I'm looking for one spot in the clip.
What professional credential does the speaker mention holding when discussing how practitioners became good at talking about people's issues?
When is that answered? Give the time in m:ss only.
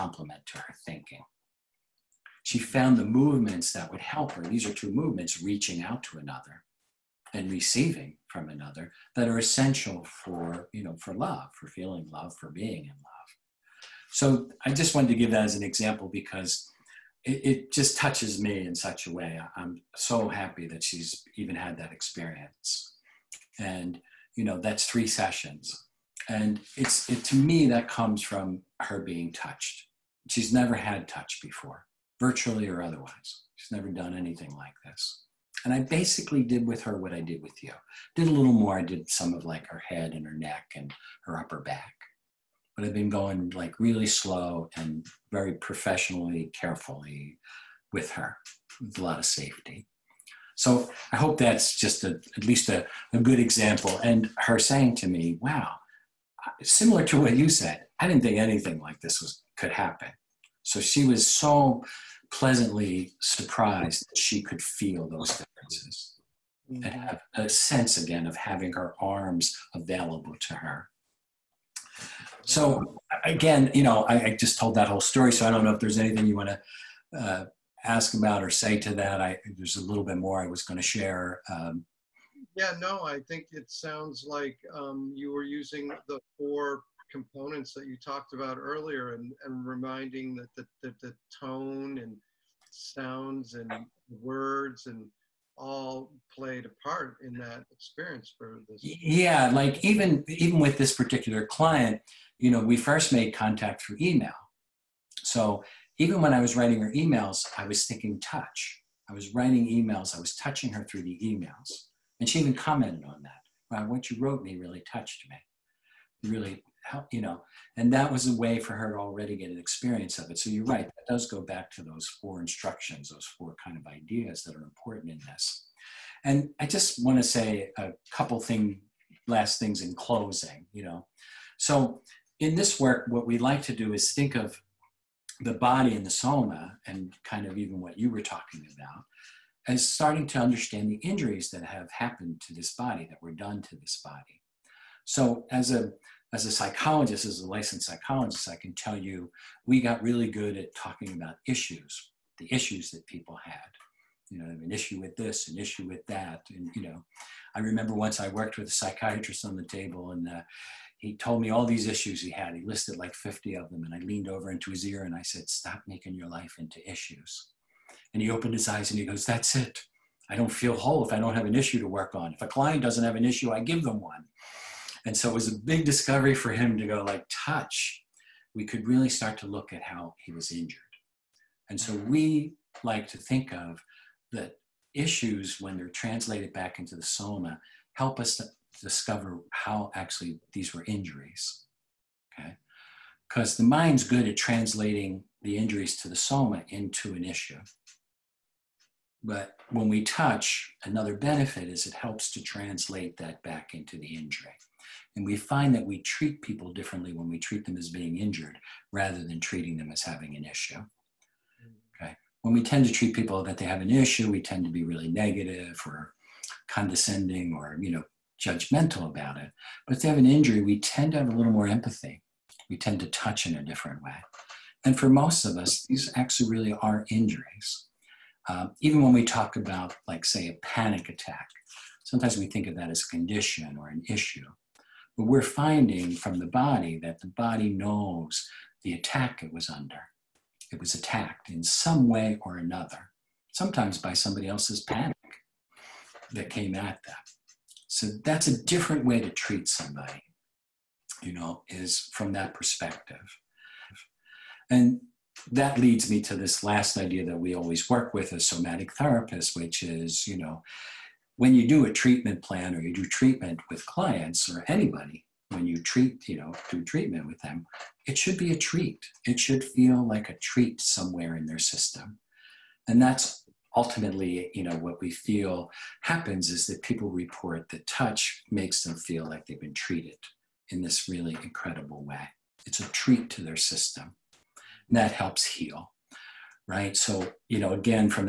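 2:27.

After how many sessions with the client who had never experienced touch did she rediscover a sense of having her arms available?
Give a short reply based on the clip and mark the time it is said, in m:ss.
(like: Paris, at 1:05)
3, at 0:24.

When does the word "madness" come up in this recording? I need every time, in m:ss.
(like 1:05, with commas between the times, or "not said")
not said.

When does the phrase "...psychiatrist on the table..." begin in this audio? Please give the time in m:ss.
2:38.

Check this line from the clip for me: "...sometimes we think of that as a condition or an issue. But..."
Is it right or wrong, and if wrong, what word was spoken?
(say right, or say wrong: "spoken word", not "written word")
right.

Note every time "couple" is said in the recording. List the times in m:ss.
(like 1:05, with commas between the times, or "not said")
2:08.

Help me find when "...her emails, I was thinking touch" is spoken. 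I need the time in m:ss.
1:46.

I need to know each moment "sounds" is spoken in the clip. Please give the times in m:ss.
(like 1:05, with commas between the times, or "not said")
1:23, 1:32.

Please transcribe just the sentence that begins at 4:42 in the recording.
It's a treat to their system.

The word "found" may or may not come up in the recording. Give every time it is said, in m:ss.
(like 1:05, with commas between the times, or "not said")
0:02.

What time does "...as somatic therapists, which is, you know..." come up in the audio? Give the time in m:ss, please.
4:18.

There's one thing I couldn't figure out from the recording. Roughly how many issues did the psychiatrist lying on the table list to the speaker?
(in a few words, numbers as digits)
50.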